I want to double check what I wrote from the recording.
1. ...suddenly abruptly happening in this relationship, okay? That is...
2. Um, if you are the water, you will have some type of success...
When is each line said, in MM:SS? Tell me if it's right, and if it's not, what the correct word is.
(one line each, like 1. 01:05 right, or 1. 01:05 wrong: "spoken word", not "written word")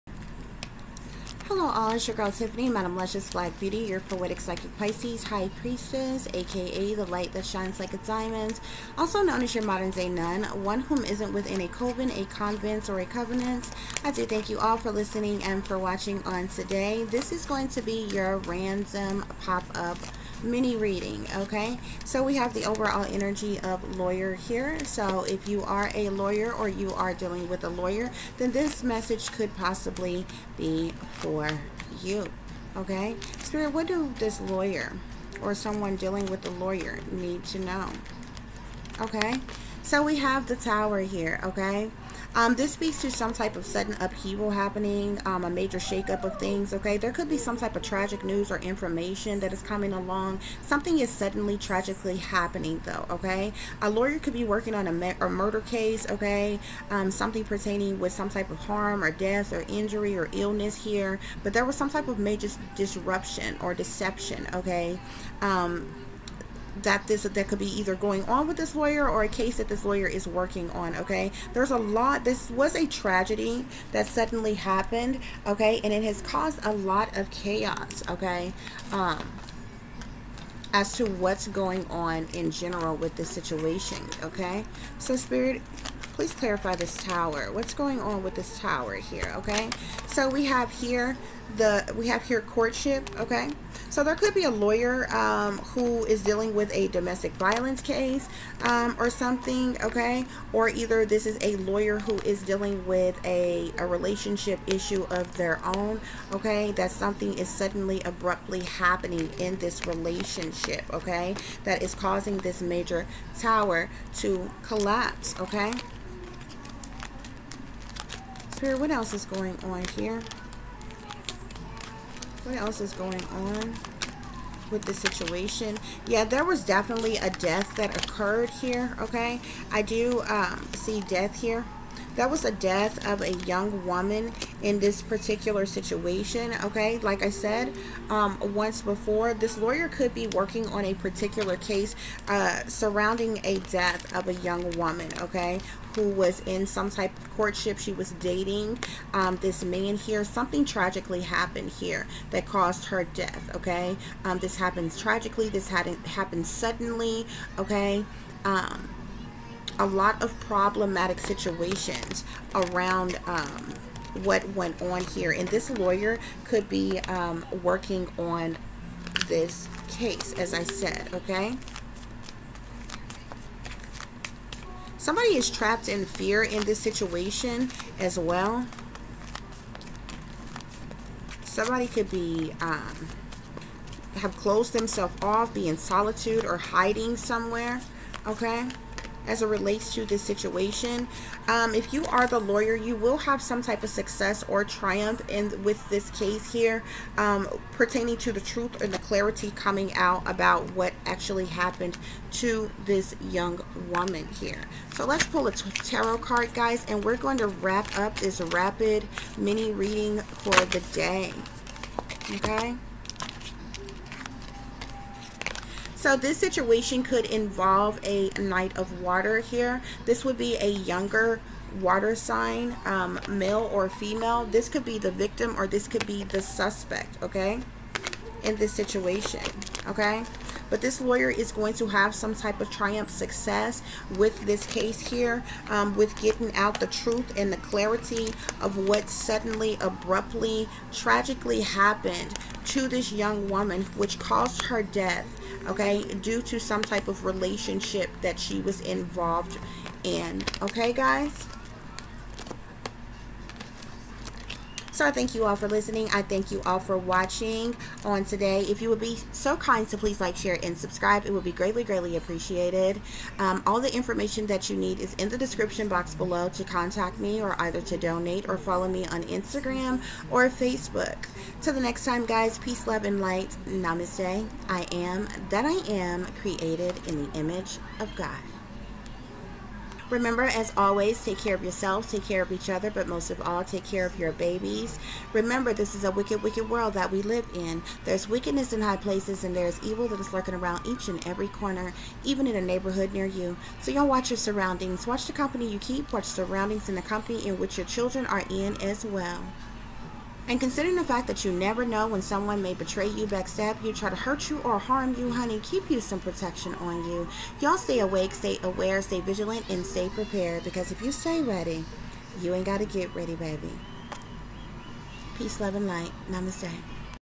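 1. 01:47 right
2. 03:11 wrong: "lawyer", not "water".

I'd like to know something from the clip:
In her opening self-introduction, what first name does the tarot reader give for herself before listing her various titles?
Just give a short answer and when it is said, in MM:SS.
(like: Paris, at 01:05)
Tiffany, at 00:02.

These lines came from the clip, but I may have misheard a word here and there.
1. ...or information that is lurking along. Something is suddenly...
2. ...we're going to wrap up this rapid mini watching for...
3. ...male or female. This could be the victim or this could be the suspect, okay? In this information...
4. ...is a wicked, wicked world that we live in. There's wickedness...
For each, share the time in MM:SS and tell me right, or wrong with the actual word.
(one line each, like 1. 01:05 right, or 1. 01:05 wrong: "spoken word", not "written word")
1. 00:48 wrong: "coming", not "lurking"
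2. 03:27 wrong: "reading", not "watching"
3. 03:43 wrong: "situation", not "information"
4. 04:45 right.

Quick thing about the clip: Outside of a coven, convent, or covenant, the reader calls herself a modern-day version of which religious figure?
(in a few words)
Nun.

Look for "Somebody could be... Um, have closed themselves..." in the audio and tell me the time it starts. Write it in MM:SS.
03:01.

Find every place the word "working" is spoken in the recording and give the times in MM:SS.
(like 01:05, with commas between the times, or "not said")
00:54, 01:10, 02:20, 02:47.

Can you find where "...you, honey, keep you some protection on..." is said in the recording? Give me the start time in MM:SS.
05:05.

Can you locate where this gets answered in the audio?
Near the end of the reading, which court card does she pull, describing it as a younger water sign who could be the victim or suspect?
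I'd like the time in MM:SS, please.
03:38.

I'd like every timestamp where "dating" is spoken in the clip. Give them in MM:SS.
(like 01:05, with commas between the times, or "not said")
02:28.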